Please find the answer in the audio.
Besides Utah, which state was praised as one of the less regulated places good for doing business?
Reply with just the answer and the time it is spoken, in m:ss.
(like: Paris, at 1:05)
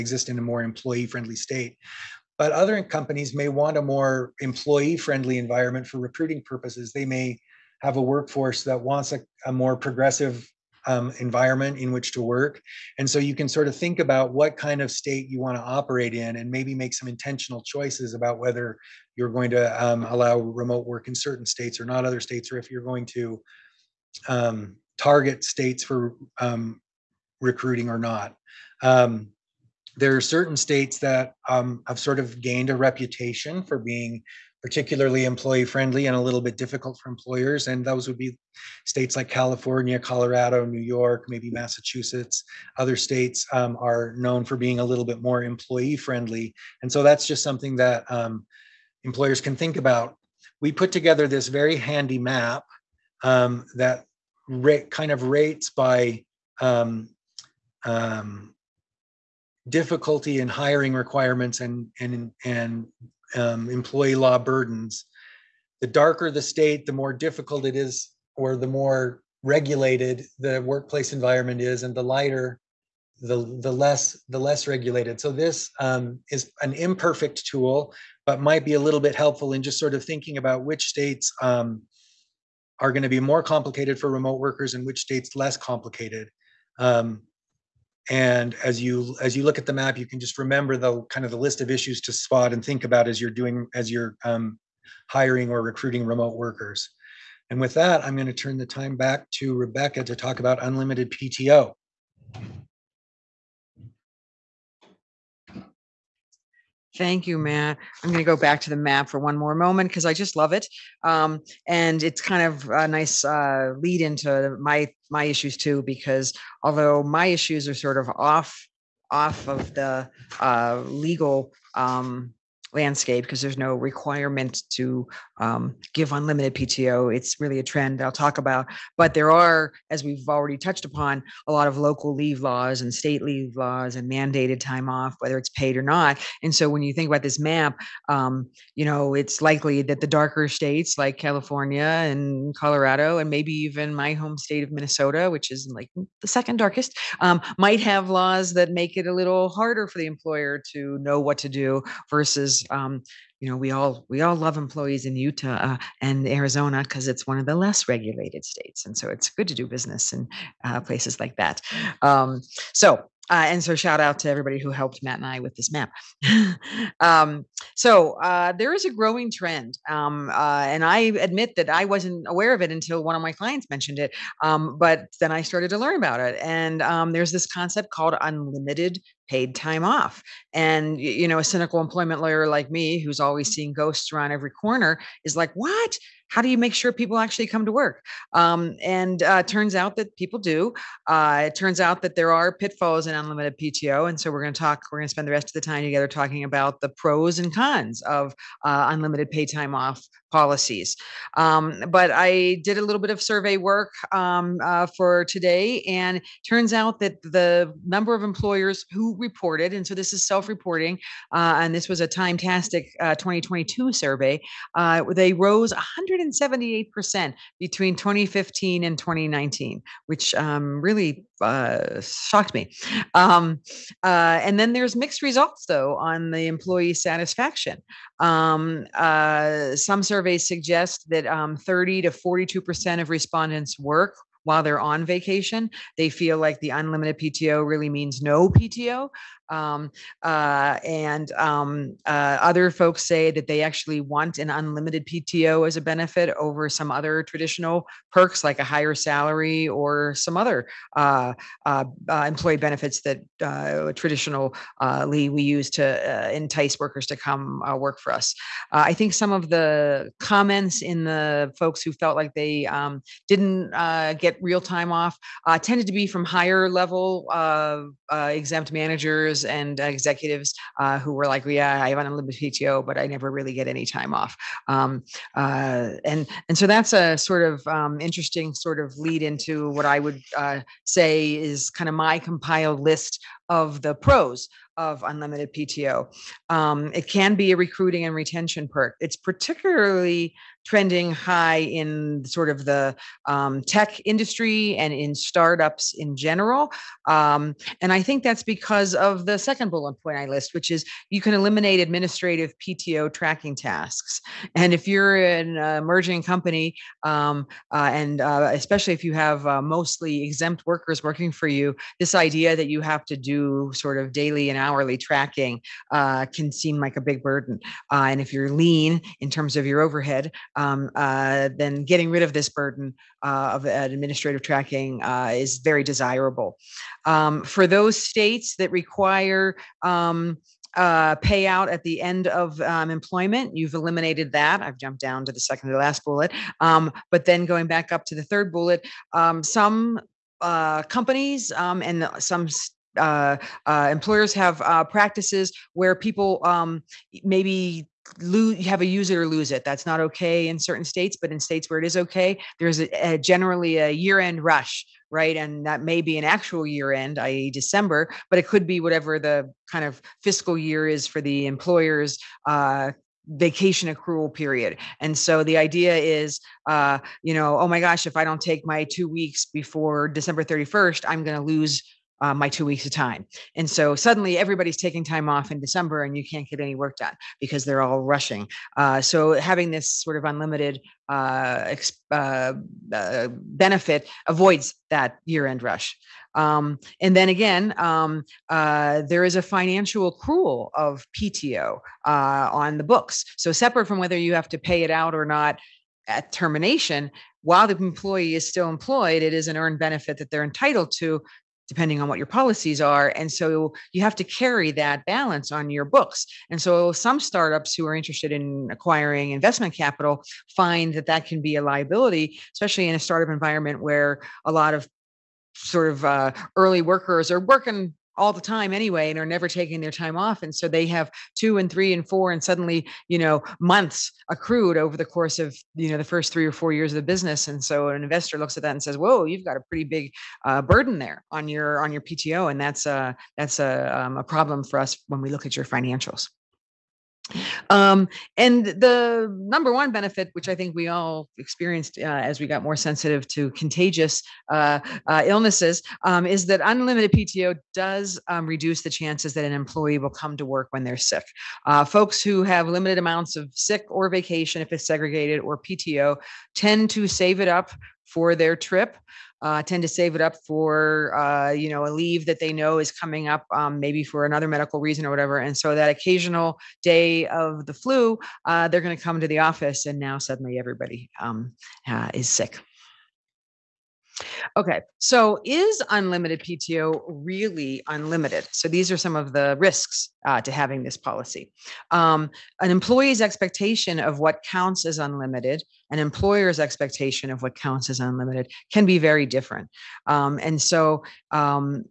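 Arizona, at 2:36.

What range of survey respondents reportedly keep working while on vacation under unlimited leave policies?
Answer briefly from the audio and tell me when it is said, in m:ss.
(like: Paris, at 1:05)
30 to 42%, at 3:51.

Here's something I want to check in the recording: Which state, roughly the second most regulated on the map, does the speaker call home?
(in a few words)
Minnesota.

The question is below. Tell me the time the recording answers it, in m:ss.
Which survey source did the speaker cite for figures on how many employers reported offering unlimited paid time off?
3:32.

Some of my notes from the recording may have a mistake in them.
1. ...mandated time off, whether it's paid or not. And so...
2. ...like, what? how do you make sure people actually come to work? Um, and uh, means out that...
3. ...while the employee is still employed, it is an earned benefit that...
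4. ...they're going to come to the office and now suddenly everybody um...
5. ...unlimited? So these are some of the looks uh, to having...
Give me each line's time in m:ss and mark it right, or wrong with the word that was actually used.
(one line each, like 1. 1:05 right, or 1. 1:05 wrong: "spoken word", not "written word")
1. 2:14 right
2. 3:05 wrong: "turns", not "means"
3. 6:37 right
4. 7:48 right
5. 7:57 wrong: "risks", not "looks".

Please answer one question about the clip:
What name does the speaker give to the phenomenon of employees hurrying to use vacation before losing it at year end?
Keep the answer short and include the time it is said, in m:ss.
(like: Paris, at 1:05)
year-end rush, at 5:53.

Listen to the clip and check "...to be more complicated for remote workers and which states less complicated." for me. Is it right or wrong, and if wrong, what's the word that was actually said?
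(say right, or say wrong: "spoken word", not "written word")
right.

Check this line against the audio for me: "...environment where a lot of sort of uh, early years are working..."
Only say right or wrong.
wrong.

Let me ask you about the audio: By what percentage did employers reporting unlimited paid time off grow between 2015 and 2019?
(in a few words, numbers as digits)
178 percent.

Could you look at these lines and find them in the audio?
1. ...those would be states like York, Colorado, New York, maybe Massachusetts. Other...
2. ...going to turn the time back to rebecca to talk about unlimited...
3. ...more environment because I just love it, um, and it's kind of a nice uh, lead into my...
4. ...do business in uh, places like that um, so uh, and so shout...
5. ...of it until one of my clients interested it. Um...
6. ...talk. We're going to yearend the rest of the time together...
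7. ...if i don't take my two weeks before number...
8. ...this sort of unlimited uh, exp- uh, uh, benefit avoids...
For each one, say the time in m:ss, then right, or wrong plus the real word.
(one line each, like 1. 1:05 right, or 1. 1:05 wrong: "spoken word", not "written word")
1. 0:37 wrong: "California", not "York"
2. 1:38 right
3. 1:49 wrong: "moment", not "environment"
4. 2:39 right
5. 2:52 wrong: "mentioned", not "interested"
6. 3:14 wrong: "spend", not "yearend"
7. 6:08 wrong: "december", not "number"
8. 6:19 right.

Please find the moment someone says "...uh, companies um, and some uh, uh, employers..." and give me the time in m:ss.
5:40.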